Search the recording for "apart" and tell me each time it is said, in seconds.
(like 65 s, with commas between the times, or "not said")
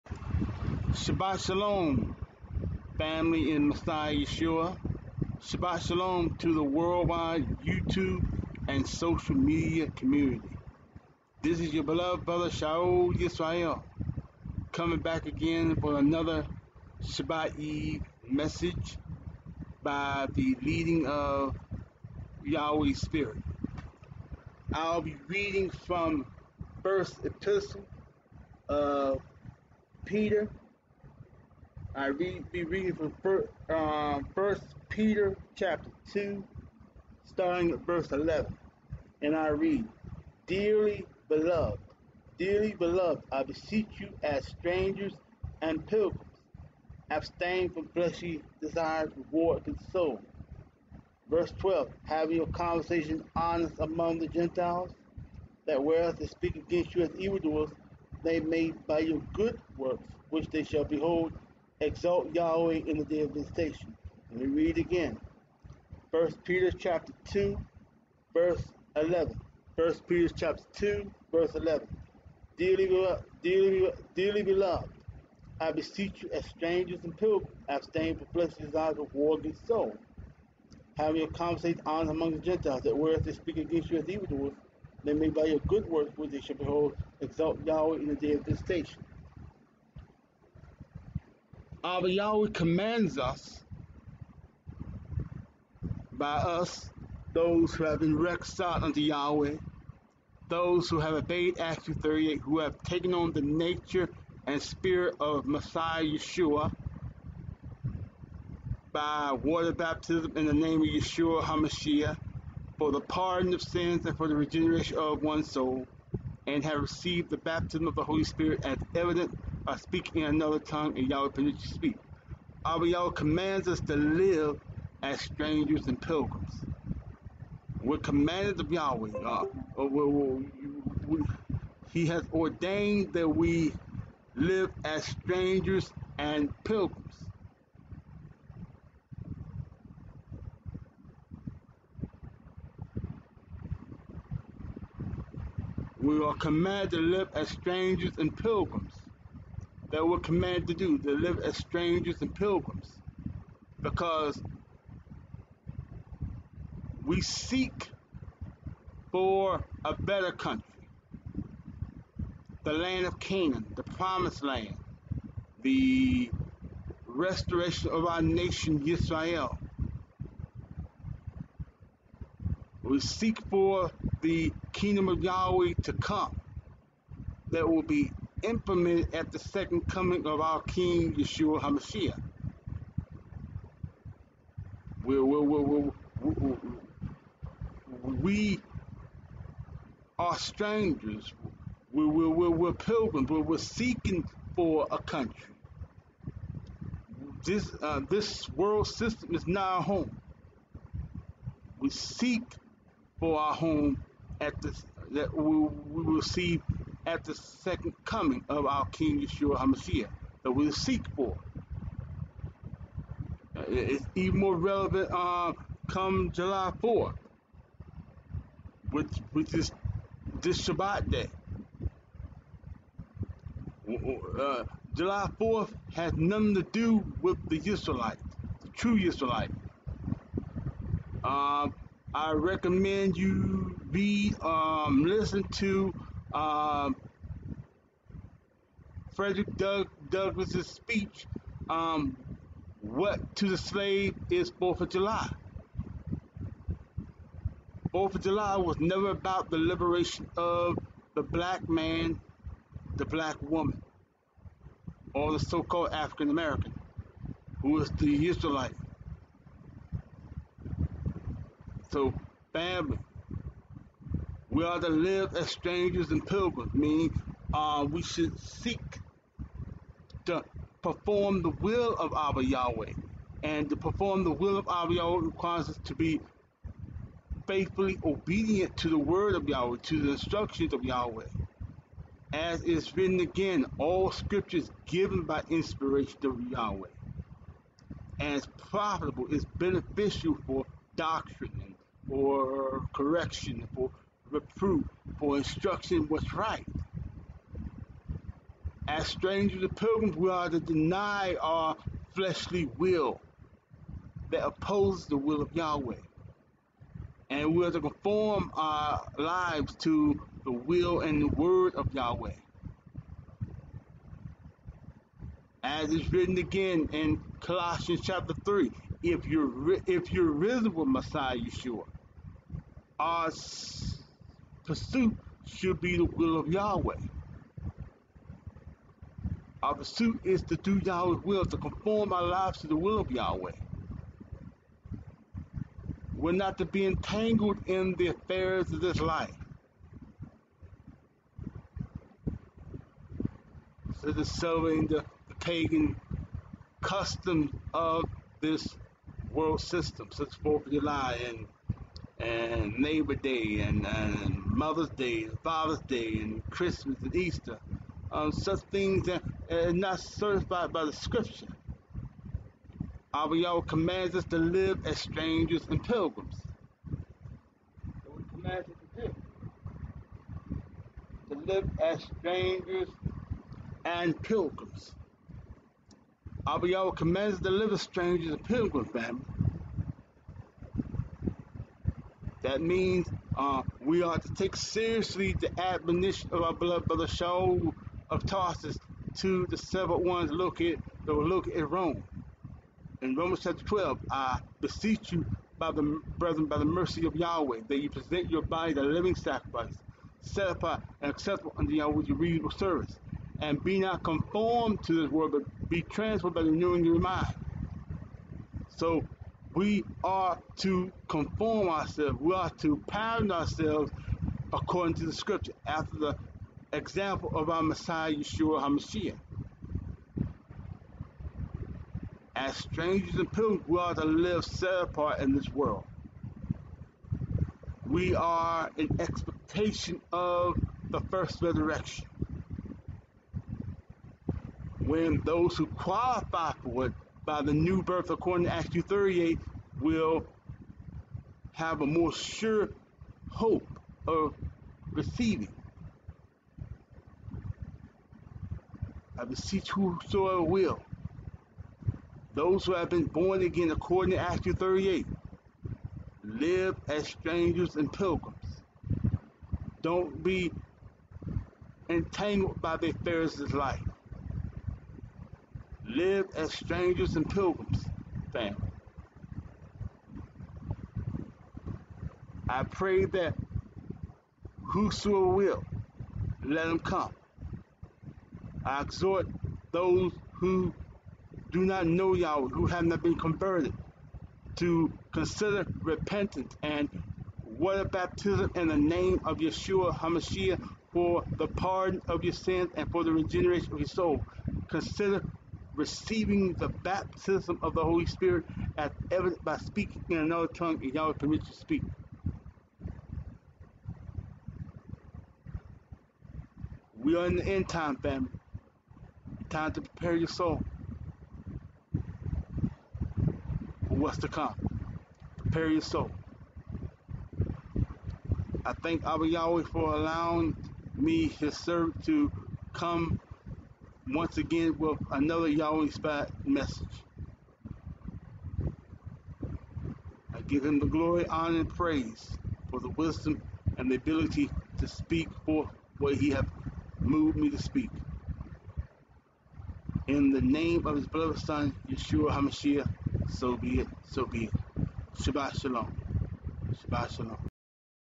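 400 s, 424 s.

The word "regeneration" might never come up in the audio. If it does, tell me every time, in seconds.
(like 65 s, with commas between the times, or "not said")
114 s, 493 s.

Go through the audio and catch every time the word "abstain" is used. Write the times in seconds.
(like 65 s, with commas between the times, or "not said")
47 s, 77 s.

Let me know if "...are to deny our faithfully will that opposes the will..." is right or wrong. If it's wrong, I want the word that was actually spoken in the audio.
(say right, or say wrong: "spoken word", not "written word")
wrong: "fleshly", not "faithfully".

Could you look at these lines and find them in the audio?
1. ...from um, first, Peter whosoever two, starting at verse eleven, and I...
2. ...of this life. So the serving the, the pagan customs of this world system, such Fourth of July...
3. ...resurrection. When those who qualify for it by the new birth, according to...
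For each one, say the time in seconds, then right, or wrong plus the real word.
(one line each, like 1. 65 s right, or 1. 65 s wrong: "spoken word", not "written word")
1. 33 s wrong: "chapter", not "whosoever"
2. 338 s right
3. 431 s right.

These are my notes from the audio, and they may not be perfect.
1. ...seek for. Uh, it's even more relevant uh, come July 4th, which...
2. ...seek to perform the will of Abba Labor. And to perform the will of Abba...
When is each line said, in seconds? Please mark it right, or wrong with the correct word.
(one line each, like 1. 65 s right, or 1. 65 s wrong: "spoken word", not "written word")
1. 210 s right
2. 268 s wrong: "Yahweh", not "Labor".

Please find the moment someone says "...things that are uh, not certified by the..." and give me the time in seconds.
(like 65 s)
358 s.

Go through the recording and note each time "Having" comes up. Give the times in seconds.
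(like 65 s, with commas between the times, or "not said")
80 s.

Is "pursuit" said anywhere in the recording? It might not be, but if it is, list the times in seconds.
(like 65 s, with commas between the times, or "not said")
324 s, 329 s.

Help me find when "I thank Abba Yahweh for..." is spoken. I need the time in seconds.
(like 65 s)
518 s.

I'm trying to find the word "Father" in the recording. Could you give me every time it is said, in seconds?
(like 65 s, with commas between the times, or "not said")
355 s.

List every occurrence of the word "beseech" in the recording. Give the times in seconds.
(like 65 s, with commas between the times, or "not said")
43 s, 75 s, 394 s, 449 s.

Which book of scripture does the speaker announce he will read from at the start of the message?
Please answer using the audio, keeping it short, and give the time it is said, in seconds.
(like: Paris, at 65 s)
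First Epistle of Peter, at 26 s.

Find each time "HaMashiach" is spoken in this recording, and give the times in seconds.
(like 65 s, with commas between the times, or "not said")
111 s, 181 s, 209 s, 418 s, 489 s, 542 s.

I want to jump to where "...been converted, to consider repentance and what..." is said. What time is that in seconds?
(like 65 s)
483 s.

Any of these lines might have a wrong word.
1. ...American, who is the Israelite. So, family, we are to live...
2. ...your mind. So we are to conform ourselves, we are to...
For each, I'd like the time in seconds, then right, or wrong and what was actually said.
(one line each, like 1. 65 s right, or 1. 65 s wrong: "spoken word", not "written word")
1. 256 s right
2. 406 s right.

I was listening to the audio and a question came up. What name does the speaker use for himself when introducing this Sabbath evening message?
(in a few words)
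Shaul Yisrael.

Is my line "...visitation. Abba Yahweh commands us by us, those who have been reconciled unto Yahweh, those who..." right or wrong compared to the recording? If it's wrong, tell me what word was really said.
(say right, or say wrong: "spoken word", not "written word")
right.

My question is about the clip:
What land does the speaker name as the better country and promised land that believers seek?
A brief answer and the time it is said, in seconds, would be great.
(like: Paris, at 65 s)
Canaan, at 162 s.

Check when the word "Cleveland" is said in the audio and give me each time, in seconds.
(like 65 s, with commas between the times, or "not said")
not said.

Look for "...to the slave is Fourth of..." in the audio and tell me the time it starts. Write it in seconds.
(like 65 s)
243 s.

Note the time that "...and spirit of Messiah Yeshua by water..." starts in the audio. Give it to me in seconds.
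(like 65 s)
104 s.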